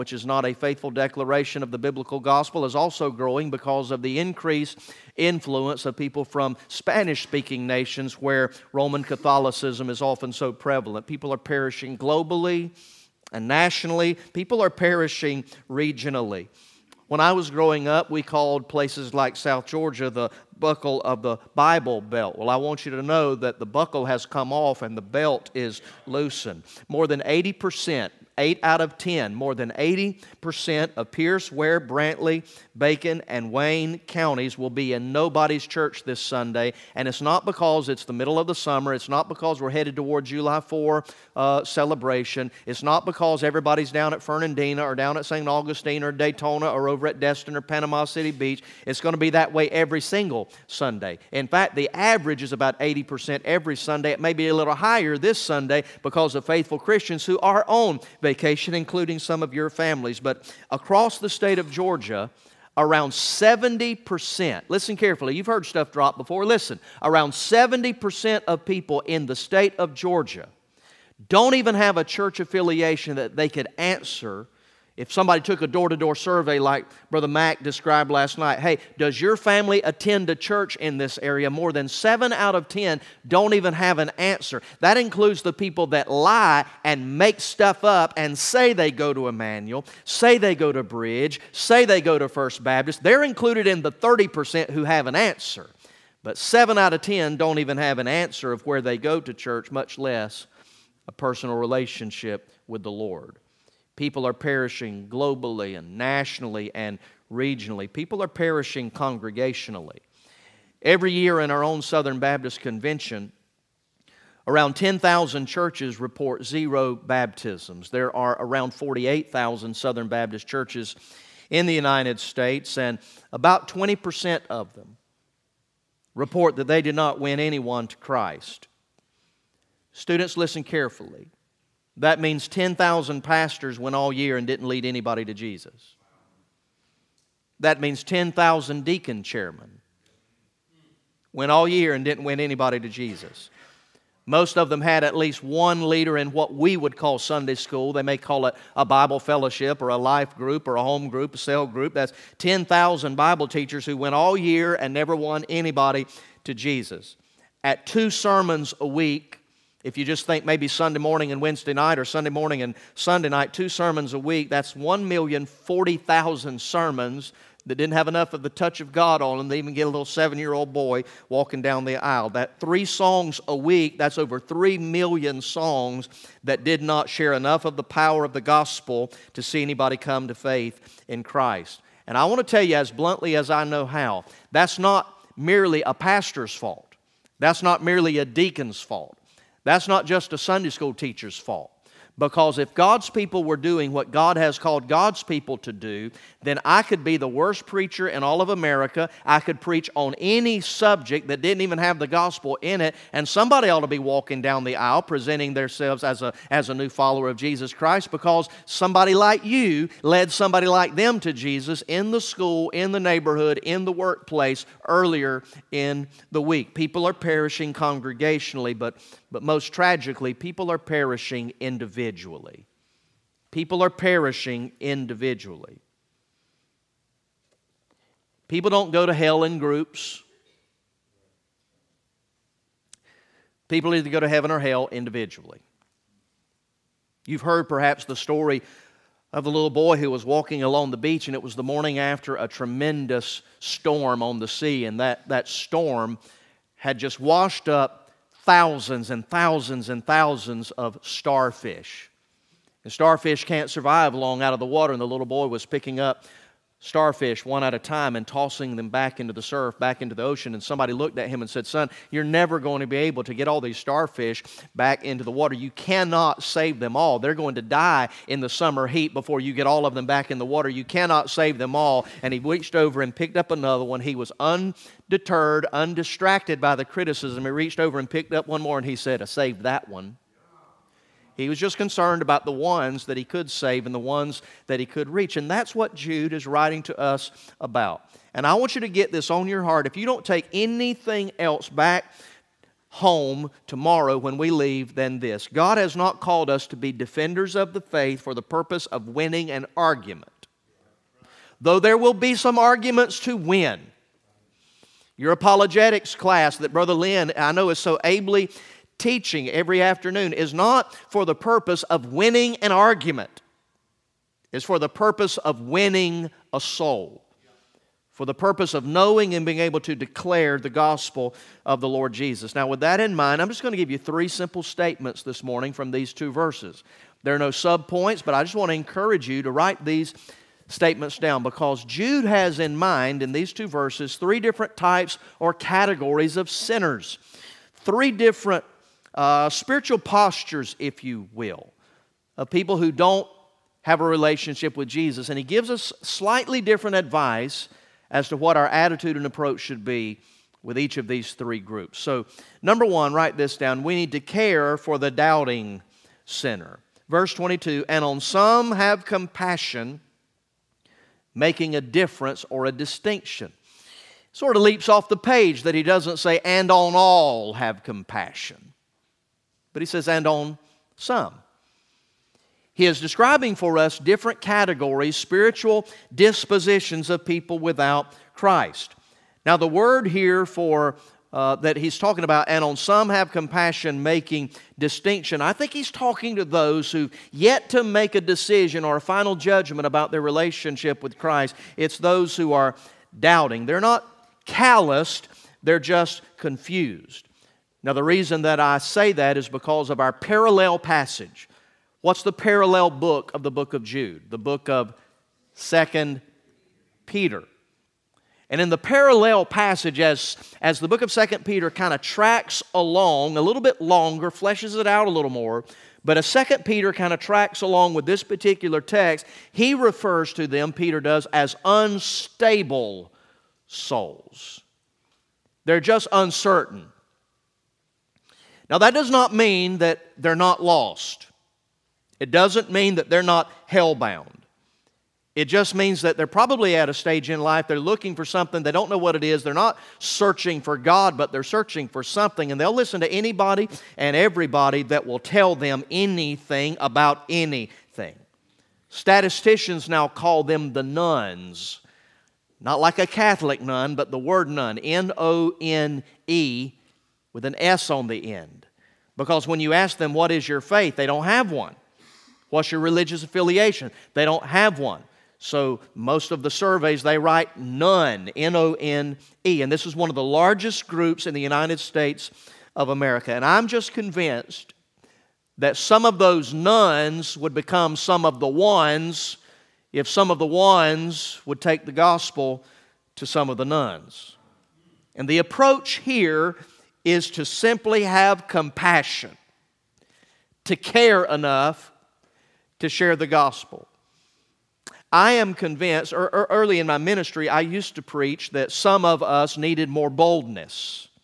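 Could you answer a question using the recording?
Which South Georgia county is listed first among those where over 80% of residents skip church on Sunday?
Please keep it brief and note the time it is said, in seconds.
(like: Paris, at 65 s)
Pierce, at 31 s.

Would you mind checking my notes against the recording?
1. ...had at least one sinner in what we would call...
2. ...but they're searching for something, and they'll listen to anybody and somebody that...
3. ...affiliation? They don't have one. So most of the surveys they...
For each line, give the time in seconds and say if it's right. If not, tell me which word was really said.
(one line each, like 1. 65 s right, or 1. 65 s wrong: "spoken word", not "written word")
1. 144 s wrong: "leader", not "sinner"
2. 441 s wrong: "everybody", not "somebody"
3. 463 s right.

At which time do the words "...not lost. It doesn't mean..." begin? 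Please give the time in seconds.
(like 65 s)
430 s.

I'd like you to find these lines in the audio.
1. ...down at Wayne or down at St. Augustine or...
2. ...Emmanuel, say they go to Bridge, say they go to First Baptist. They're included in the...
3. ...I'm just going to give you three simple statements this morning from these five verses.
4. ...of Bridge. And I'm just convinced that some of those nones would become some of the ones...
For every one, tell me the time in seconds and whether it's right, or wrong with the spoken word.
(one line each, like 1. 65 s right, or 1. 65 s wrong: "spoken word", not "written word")
1. 43 s wrong: "Fernandina", not "Wayne"
2. 89 s right
3. 323 s wrong: "two", not "five"
4. 472 s wrong: "America", not "Bridge".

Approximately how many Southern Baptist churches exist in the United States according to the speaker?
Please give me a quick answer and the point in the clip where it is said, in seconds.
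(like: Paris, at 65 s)
48,000, at 118 s.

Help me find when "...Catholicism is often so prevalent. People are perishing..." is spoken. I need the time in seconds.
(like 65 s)
9 s.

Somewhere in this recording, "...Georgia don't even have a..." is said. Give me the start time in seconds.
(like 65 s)
69 s.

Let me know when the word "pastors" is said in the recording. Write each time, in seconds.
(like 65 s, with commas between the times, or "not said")
133 s, 185 s.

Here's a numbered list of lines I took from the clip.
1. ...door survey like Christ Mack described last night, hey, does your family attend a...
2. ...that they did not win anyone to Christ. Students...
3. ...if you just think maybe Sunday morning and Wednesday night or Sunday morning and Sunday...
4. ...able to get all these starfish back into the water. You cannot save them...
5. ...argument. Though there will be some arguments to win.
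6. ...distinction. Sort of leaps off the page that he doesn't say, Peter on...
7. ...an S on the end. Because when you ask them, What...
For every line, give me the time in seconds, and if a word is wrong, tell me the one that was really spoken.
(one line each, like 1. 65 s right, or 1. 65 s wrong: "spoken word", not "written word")
1. 75 s wrong: "Brother", not "Christ"
2. 126 s right
3. 159 s right
4. 262 s right
5. 299 s right
6. 362 s wrong: "And", not "Peter"
7. 457 s right.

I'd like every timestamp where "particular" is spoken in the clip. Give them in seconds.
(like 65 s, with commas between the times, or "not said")
418 s.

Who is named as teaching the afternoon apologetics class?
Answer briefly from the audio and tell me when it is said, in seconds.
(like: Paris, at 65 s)
Brother Lynn, at 306 s.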